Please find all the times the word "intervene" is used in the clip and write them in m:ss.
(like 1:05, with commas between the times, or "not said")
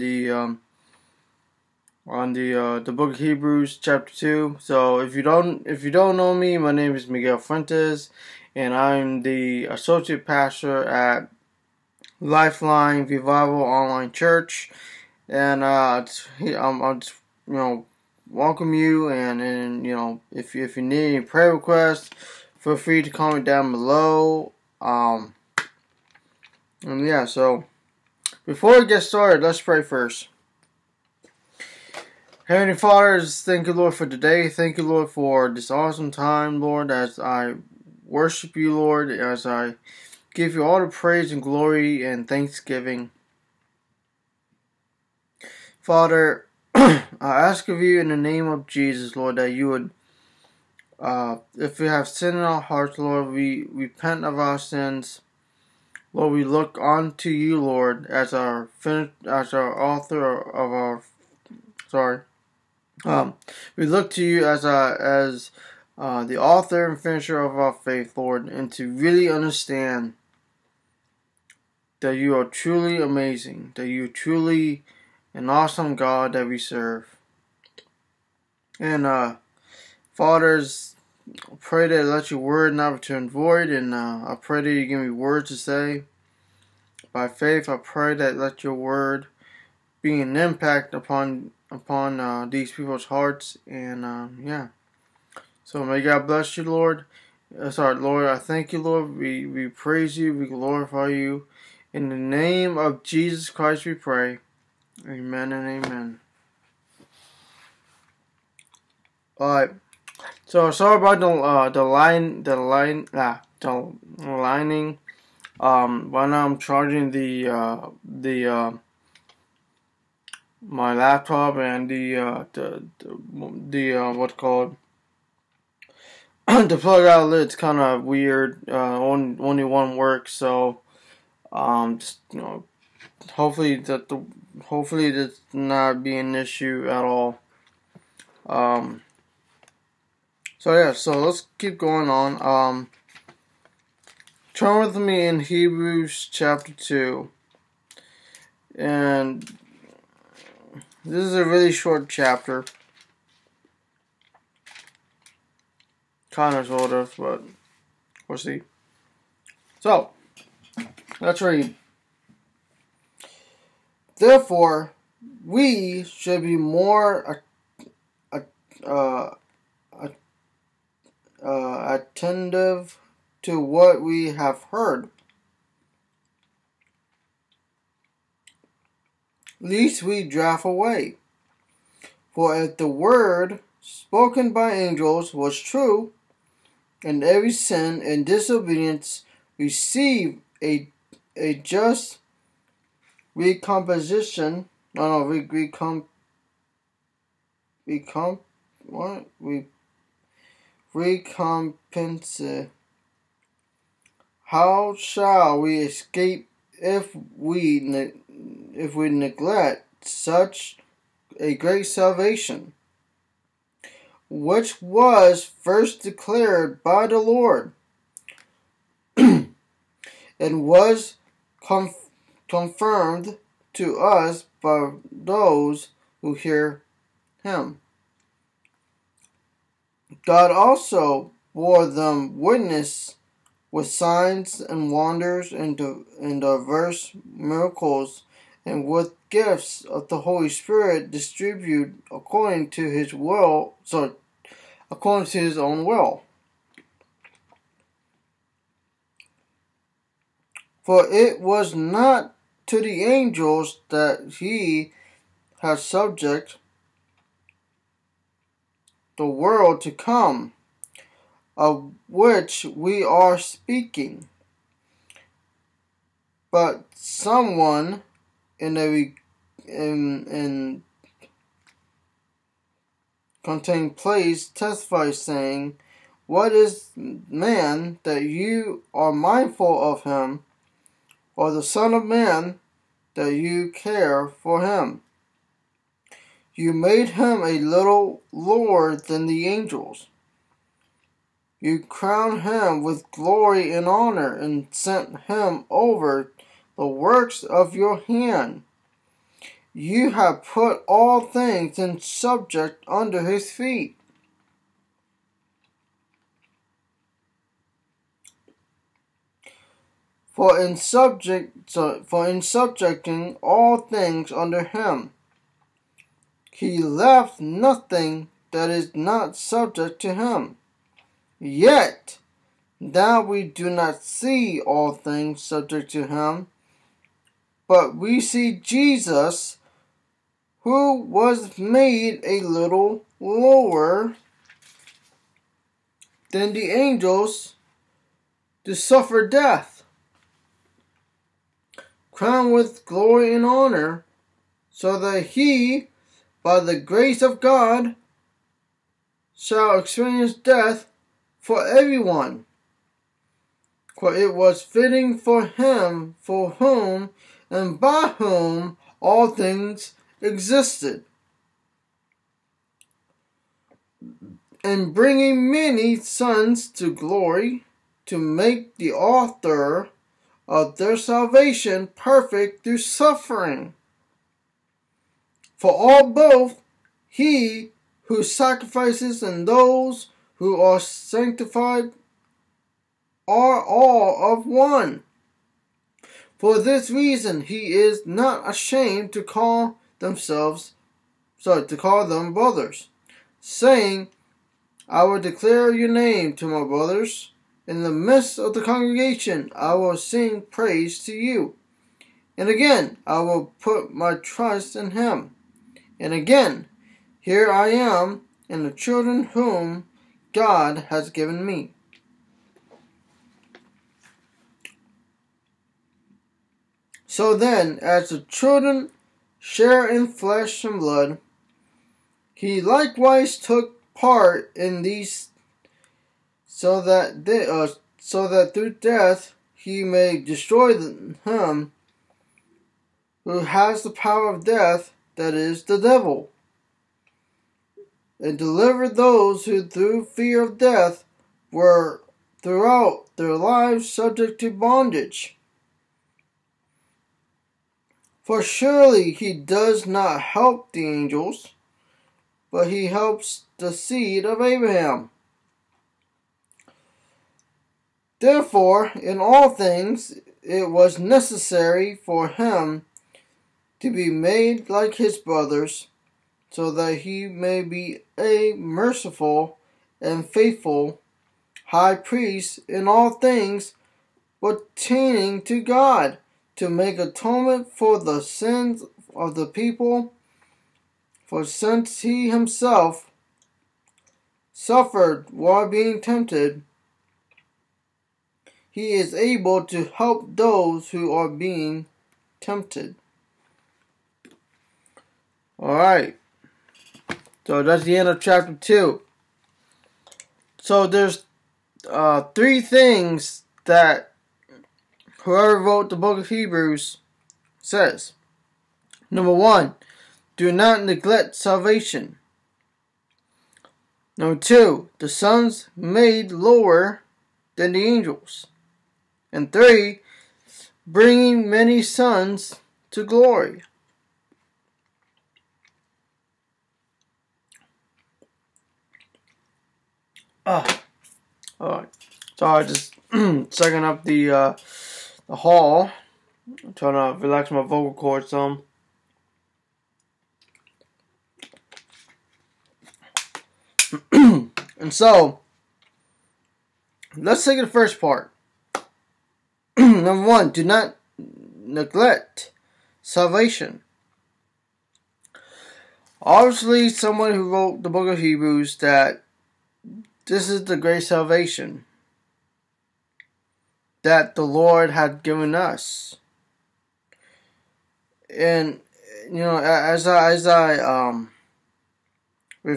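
not said.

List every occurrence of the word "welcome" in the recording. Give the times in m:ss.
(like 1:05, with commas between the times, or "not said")
0:18.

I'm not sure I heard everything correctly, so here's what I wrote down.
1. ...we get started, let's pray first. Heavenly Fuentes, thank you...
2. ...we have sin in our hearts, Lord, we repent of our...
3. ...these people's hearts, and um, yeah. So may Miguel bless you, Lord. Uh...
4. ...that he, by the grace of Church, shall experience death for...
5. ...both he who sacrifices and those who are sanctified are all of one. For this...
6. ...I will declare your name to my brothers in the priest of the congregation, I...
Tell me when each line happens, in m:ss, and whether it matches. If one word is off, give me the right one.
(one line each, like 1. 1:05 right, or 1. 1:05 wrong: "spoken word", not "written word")
1. 0:28 wrong: "Father", not "Fuentes"
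2. 0:51 right
3. 1:32 wrong: "God", not "Miguel"
4. 5:44 wrong: "God", not "Church"
5. 6:16 right
6. 6:34 wrong: "midst", not "priest".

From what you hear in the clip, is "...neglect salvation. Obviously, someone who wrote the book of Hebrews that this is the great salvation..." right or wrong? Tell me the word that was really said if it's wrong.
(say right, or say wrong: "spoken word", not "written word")
right.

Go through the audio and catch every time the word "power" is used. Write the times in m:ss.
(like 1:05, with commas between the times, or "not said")
7:13.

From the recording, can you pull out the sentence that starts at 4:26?
But someone in a in, in contained place testifies saying, What is man that you are mindful of him?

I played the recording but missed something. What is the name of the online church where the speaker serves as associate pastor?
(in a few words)
Lifeline Revival Online Church.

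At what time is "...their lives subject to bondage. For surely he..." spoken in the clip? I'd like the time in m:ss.
7:23.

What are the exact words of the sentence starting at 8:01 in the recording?
For since he himself suffered while being tempted, he is able to help those who are being tempted.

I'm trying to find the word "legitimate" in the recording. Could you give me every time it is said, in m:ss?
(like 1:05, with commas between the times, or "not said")
not said.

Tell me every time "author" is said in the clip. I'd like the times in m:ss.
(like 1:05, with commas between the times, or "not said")
0:59, 1:06, 6:08.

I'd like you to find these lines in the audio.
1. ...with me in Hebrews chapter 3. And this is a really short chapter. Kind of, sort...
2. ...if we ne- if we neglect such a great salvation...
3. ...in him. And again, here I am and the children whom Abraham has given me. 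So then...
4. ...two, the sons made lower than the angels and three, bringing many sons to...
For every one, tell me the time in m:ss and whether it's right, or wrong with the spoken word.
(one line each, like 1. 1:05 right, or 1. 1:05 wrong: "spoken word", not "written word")
1. 2:24 wrong: "2", not "3"
2. 3:26 right
3. 6:44 wrong: "God", not "Abraham"
4. 8:34 right.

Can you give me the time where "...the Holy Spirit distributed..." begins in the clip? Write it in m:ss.
4:00.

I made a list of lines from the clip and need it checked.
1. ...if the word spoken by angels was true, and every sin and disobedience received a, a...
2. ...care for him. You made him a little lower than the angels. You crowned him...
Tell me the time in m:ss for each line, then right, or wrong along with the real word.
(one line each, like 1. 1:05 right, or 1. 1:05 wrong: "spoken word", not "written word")
1. 3:02 right
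2. 4:43 right.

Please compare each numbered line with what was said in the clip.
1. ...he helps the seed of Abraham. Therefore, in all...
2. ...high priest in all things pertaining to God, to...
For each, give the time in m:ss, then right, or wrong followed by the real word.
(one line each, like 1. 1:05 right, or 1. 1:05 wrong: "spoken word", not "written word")
1. 7:32 right
2. 7:51 right.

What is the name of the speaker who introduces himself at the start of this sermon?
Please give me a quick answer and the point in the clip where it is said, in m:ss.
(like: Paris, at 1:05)
Miguel Fuentes, at 0:07.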